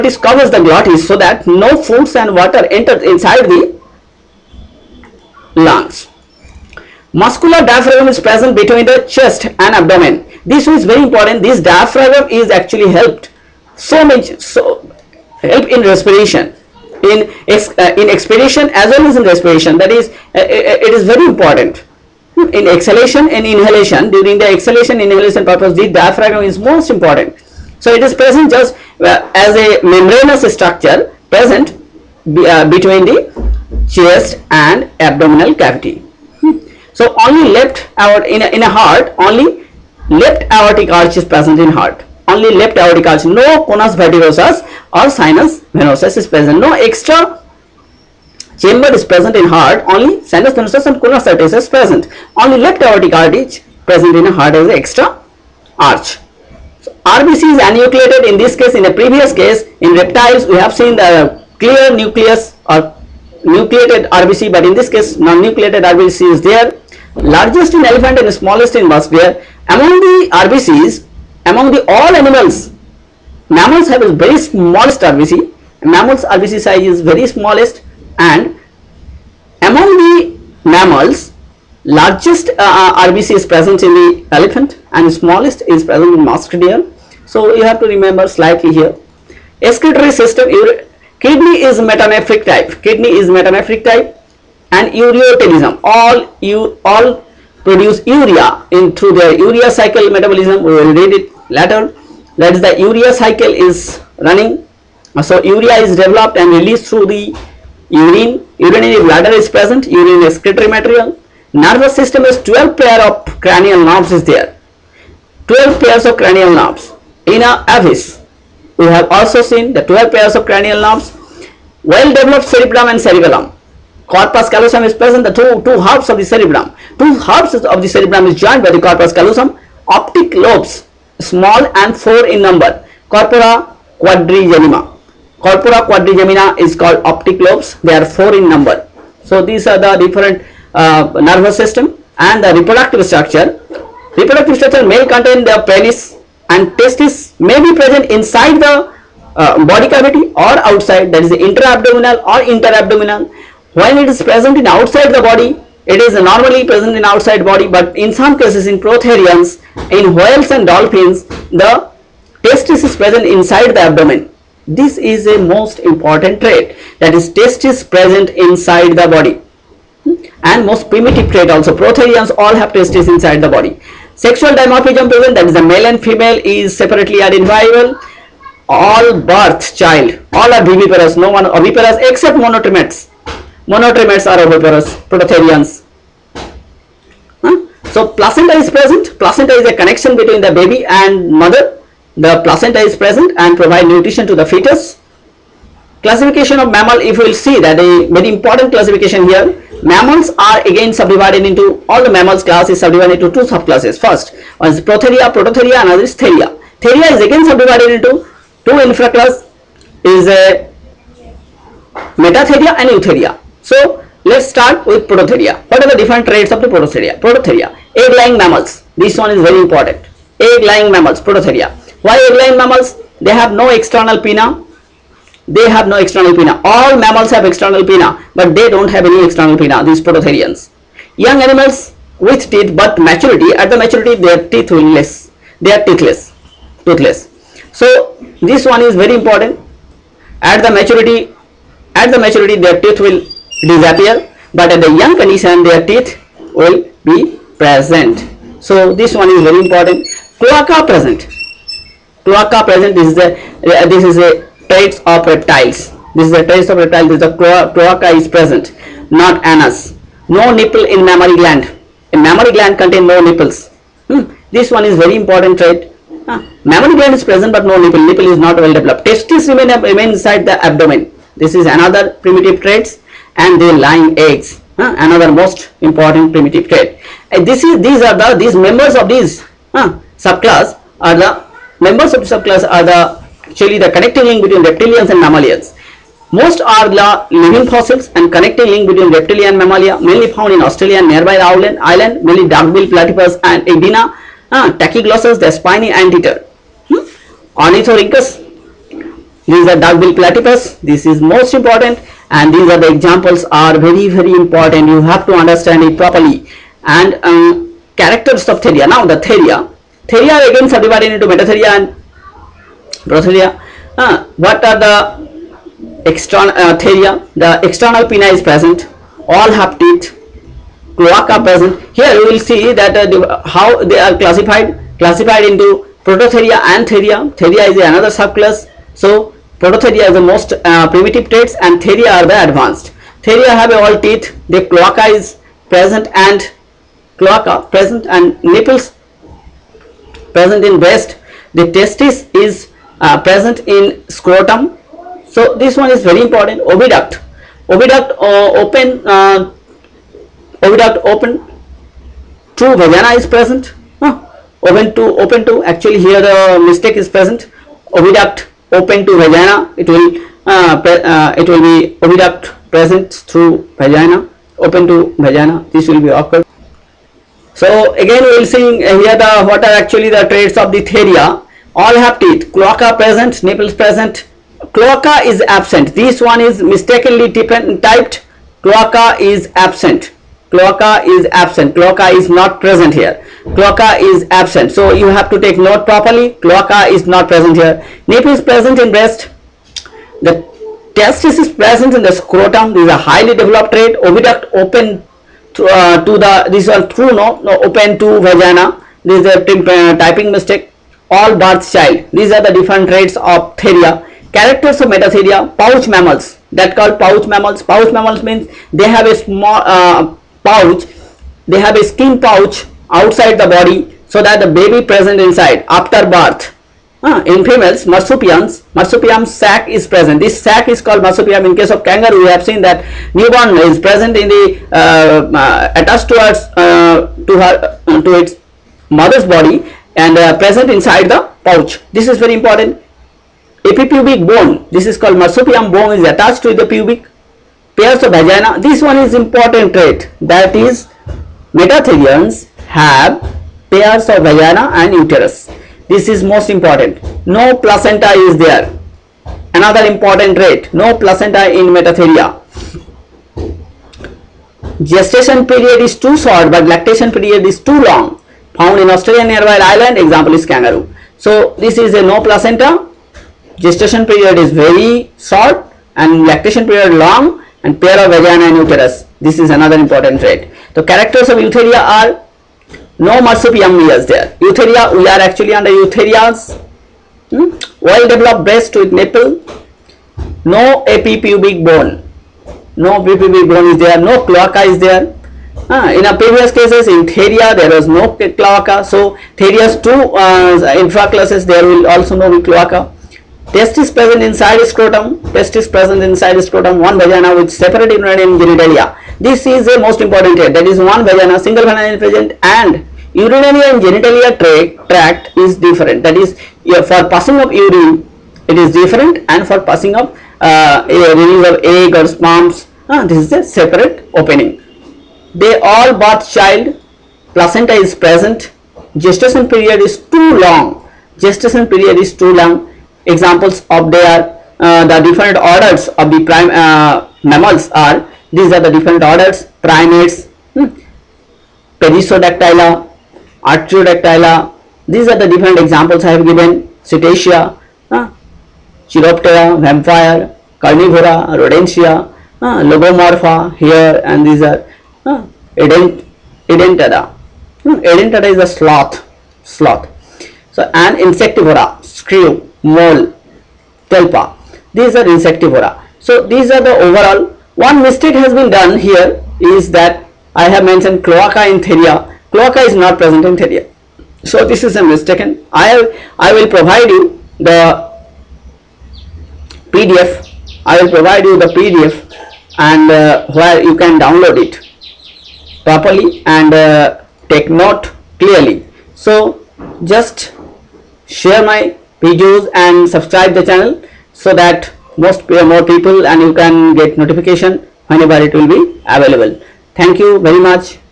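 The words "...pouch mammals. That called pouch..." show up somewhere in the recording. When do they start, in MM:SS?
06:45.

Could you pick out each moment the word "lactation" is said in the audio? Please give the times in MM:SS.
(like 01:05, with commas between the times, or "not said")
07:36, 07:46.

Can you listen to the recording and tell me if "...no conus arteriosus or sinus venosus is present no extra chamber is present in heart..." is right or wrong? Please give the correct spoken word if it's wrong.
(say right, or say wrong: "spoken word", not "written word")
right.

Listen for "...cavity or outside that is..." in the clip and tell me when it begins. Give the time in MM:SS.
02:29.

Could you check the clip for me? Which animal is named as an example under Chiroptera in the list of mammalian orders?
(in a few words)
Vampire.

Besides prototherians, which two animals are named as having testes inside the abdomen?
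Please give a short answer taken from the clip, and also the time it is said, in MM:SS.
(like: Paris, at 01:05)
Whales and dolphins, at 02:40.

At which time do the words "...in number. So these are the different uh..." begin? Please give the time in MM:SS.
02:18.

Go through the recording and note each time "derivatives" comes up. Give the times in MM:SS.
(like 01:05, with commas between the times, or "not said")
not said.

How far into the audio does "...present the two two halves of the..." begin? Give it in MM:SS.
02:04.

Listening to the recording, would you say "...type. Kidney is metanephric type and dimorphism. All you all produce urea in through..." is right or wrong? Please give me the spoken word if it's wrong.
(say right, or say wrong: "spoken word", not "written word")
wrong: "ureotelism", not "dimorphism".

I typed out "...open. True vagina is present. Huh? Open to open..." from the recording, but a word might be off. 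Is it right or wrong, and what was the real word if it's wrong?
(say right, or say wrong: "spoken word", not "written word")
right.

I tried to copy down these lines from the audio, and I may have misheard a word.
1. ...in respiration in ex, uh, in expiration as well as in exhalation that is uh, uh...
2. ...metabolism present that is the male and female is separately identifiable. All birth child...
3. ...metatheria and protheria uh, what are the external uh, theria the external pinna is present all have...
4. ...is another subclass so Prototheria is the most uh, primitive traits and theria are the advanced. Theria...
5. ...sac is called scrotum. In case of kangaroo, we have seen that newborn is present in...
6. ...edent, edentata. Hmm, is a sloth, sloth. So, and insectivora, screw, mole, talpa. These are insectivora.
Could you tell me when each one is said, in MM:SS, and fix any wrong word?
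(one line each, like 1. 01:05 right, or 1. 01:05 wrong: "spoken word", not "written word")
1. 00:15 wrong: "respiration", not "exhalation"
2. 02:54 wrong: "dimorphism", not "metabolism"
3. 05:11 right
4. 05:27 right
5. 07:00 wrong: "marsupium", not "scrotum"
6. 09:05 right.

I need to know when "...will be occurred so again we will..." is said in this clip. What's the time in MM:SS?
06:05.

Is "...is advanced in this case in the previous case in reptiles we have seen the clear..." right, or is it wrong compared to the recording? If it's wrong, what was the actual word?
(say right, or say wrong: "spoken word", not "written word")
wrong: "anenucleated", not "advanced".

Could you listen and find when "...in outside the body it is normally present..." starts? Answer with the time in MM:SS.
02:34.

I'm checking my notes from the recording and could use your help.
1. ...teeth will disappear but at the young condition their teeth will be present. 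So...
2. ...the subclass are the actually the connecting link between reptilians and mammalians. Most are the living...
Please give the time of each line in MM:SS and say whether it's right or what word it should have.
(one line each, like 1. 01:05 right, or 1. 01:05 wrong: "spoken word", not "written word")
1. 04:02 right
2. 04:42 right.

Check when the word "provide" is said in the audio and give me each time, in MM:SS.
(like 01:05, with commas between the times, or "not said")
03:13, 09:26, 09:30.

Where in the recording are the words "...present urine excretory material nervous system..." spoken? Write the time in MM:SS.
01:49.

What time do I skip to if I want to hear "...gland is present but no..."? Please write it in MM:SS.
04:26.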